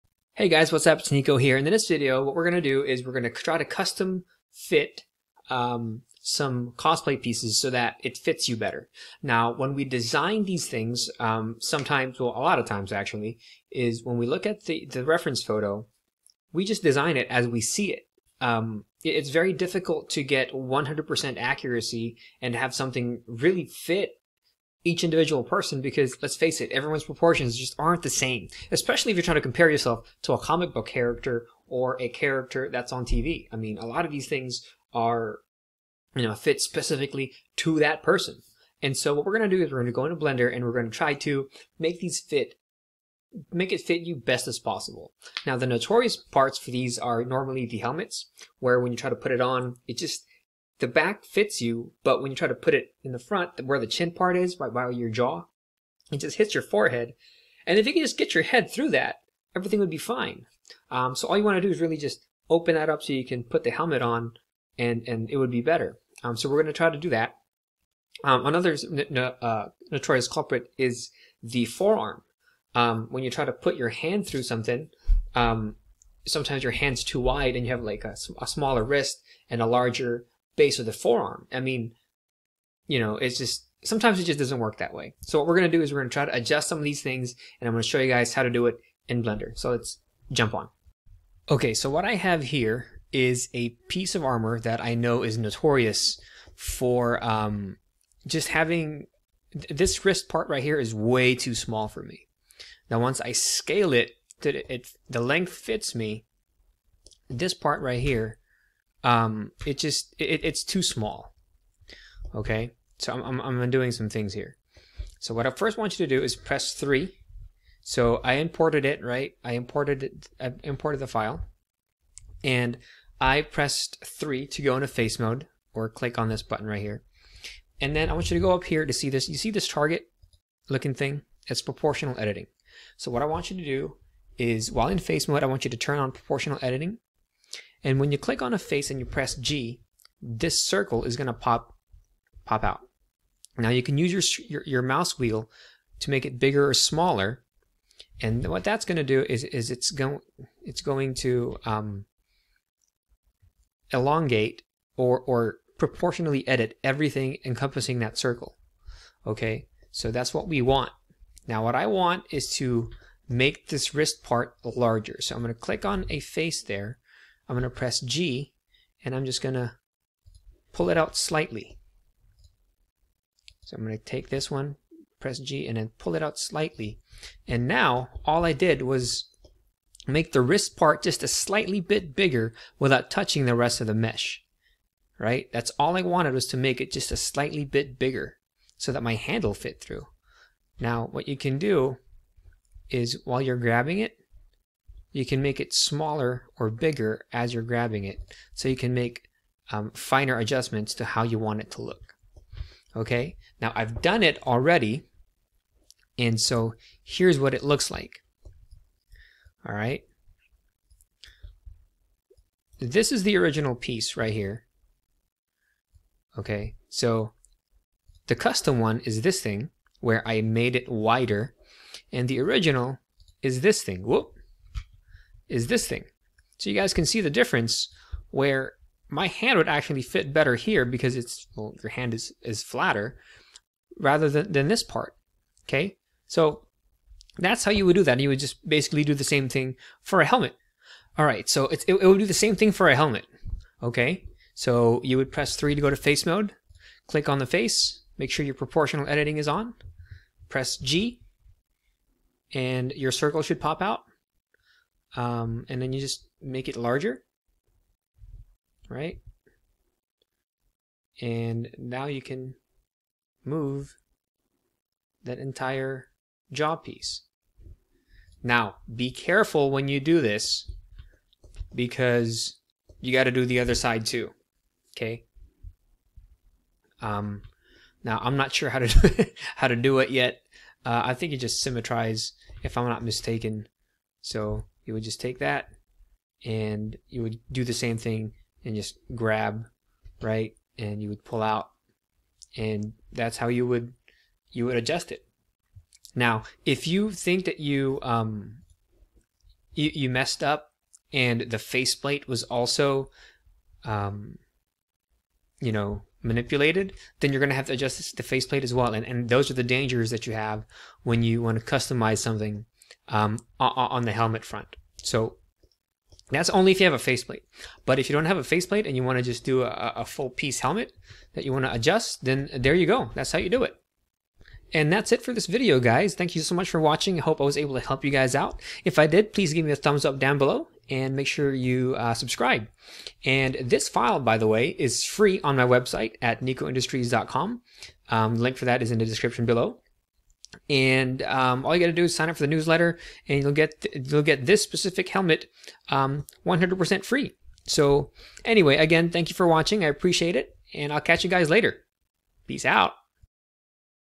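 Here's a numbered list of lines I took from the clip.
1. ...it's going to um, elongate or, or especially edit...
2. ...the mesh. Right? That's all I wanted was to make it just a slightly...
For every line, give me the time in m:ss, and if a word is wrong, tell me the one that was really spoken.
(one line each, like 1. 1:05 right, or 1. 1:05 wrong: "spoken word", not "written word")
1. 2:30 wrong: "proportionally", not "especially"
2. 3:03 right.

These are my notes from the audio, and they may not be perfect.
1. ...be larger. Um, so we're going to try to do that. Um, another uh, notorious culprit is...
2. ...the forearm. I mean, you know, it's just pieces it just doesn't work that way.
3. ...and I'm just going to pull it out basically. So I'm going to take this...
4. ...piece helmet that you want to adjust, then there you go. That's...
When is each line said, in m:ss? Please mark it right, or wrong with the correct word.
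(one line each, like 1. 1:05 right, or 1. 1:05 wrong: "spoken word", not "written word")
1. 1:05 wrong: "better", not "larger"
2. 1:20 wrong: "sometimes", not "pieces"
3. 2:49 wrong: "slightly", not "basically"
4. 5:20 right.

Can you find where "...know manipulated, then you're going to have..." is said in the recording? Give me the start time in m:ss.
5:05.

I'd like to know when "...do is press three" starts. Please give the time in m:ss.
1:56.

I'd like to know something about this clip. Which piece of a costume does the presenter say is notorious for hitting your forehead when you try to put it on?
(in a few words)
Helmets.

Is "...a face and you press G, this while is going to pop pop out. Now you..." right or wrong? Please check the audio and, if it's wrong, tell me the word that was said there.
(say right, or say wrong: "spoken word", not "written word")
wrong: "circle", not "while".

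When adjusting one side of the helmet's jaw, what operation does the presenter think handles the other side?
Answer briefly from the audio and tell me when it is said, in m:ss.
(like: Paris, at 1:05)
Symmetrize, at 4:41.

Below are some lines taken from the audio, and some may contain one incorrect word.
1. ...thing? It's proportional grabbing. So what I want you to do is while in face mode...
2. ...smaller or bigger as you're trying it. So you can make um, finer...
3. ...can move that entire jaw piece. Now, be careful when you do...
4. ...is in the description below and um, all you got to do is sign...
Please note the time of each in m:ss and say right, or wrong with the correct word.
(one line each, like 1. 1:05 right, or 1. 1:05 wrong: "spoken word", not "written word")
1. 2:10 wrong: "editing", not "grabbing"
2. 3:15 wrong: "grabbing", not "trying"
3. 4:22 right
4. 5:38 right.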